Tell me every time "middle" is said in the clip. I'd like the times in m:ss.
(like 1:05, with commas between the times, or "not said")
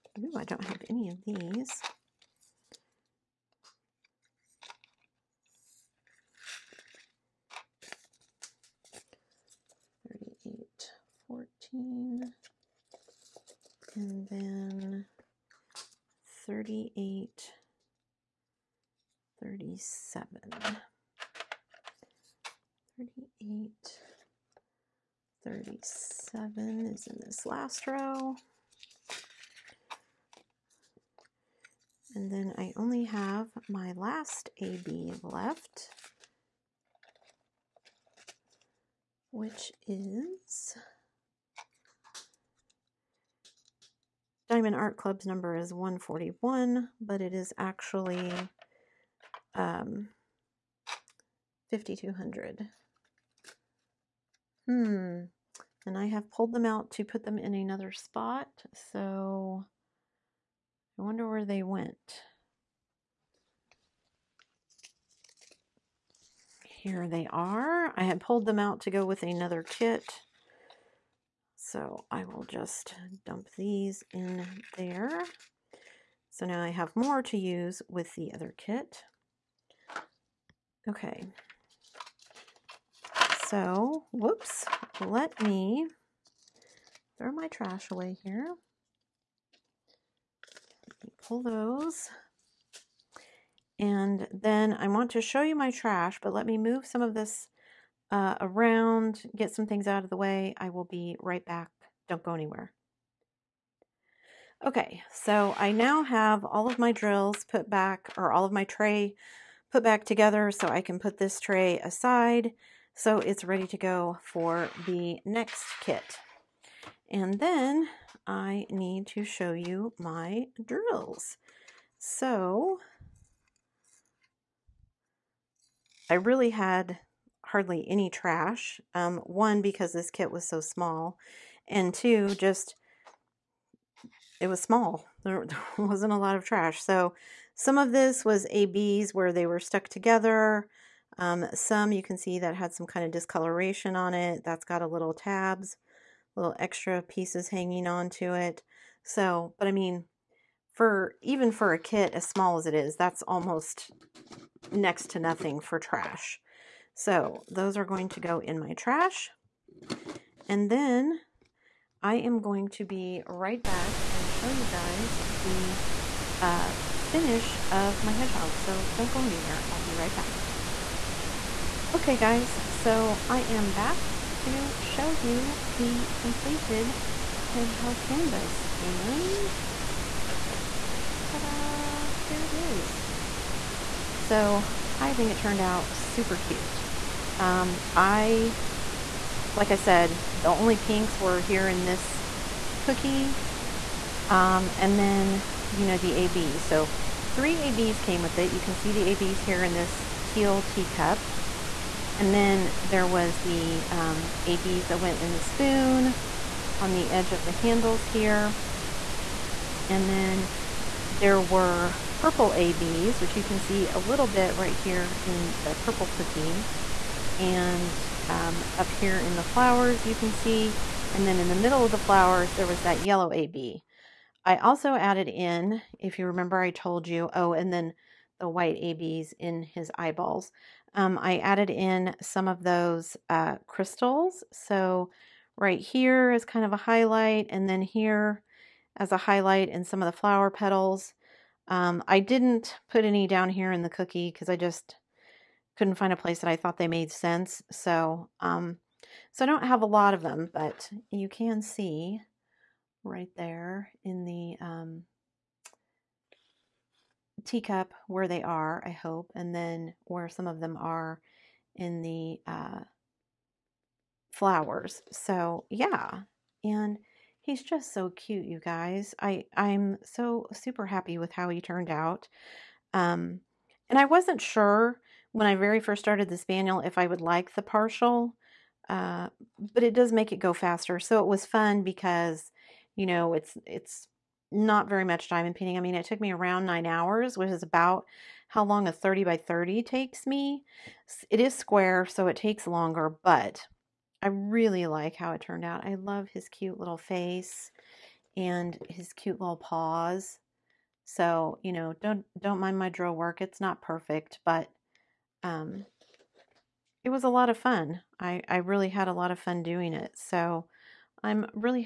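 3:41.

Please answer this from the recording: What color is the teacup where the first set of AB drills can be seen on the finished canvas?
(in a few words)
Teal.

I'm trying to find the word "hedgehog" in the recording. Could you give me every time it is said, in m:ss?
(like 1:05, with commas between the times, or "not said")
2:48, 2:57.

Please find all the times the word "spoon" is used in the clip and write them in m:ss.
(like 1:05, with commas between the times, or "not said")
3:25.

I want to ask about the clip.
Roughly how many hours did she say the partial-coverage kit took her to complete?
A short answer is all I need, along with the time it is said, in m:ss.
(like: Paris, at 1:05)
9 hours, at 4:46.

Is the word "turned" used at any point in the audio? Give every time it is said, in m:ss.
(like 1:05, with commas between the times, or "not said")
3:05, 4:31, 4:55.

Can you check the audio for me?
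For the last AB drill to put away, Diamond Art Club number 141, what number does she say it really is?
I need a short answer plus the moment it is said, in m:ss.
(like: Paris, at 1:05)
5200, at 0:51.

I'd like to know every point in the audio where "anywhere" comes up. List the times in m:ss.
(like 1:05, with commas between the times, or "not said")
1:42, 2:49.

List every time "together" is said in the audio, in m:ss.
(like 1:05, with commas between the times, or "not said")
1:50, 2:19.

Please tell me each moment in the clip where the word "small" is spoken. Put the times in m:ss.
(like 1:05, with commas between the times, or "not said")
2:10, 2:14, 2:32.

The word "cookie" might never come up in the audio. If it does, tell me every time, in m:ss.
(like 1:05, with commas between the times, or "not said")
3:12, 3:36, 4:03.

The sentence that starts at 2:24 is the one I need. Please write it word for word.
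That's got a little tabs little extra pieces hanging on to it.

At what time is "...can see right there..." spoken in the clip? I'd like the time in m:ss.
4:11.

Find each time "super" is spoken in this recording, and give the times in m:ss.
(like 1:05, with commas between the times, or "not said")
3:05, 4:30.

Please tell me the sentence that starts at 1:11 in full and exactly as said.
So I will just dump these in there.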